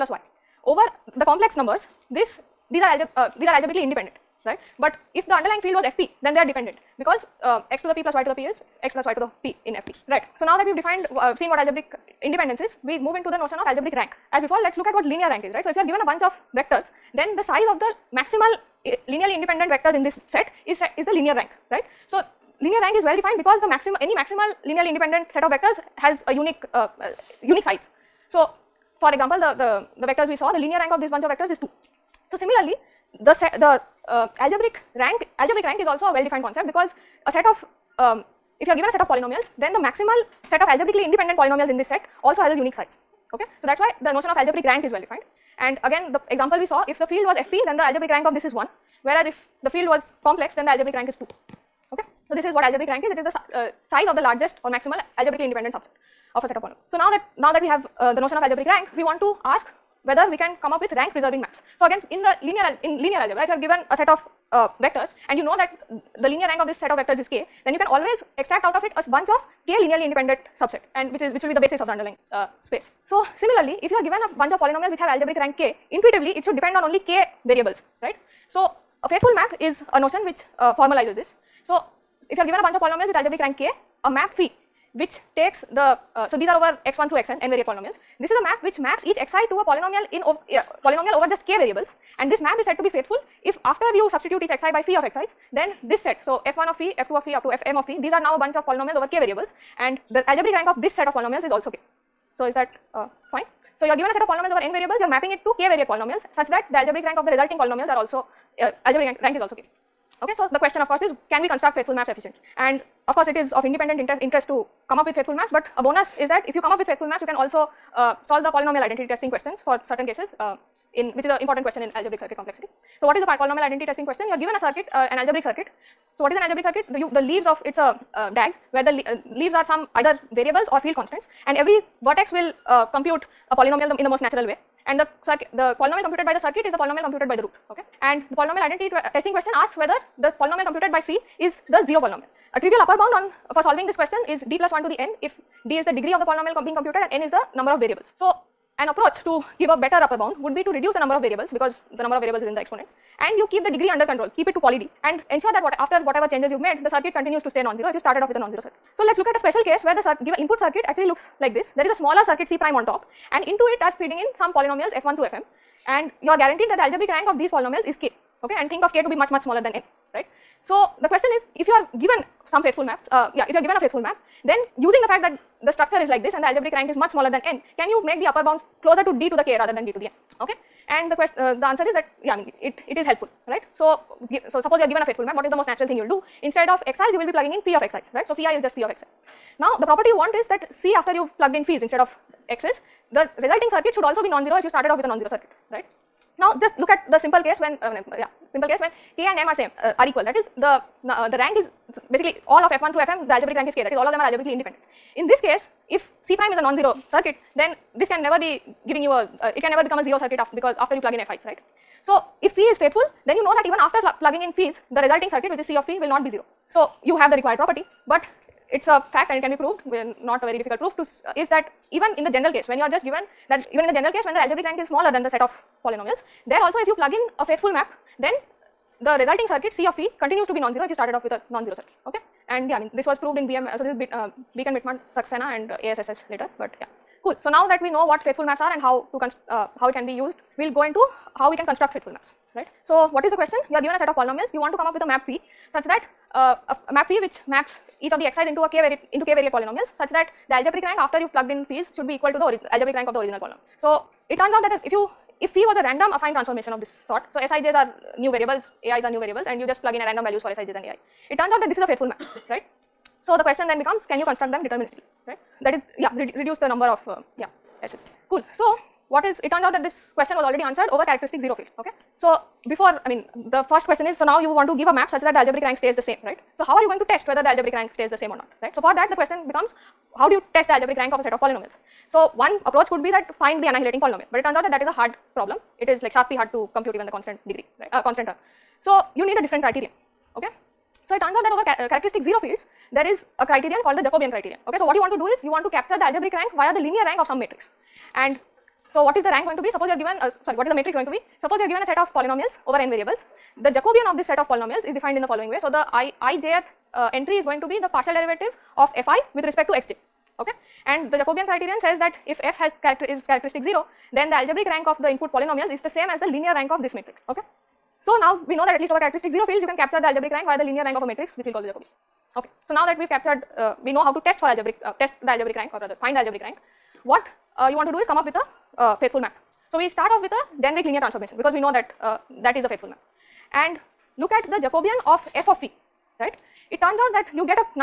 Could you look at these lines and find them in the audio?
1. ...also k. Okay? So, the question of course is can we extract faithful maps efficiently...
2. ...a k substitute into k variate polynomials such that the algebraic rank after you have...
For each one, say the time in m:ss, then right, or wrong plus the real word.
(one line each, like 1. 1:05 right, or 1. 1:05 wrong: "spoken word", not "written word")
1. 1:49 wrong: "construct", not "extract"
2. 4:08 wrong: "variate", not "substitute".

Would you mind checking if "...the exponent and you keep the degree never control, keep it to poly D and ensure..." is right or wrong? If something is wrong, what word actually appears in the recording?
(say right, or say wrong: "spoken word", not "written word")
wrong: "under", not "never".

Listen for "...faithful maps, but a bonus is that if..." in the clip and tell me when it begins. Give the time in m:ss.
1:55.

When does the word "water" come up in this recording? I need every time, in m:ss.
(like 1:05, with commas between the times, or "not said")
not said.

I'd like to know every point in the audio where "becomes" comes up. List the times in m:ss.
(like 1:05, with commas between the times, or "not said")
3:29, 4:23, 4:39.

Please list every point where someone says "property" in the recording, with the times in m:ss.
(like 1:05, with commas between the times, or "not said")
3:09, 3:37.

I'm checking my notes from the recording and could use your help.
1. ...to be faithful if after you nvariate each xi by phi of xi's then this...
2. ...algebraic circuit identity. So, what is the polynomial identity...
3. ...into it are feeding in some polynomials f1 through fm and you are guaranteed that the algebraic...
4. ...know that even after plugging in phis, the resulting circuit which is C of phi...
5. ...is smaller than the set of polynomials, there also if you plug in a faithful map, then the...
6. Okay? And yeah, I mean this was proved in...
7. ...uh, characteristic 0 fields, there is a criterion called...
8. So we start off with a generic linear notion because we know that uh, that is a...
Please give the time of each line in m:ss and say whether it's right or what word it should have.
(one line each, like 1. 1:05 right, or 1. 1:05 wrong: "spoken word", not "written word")
1. 1:32 wrong: "substitute", not "nvariate"
2. 2:01 wrong: "complexity", not "identity"
3. 2:43 right
4. 3:33 right
5. 3:44 right
6. 3:52 right
7. 4:51 right
8. 5:29 wrong: "transformation", not "notion".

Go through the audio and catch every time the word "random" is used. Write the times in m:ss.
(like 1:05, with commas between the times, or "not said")
4:15, 4:20.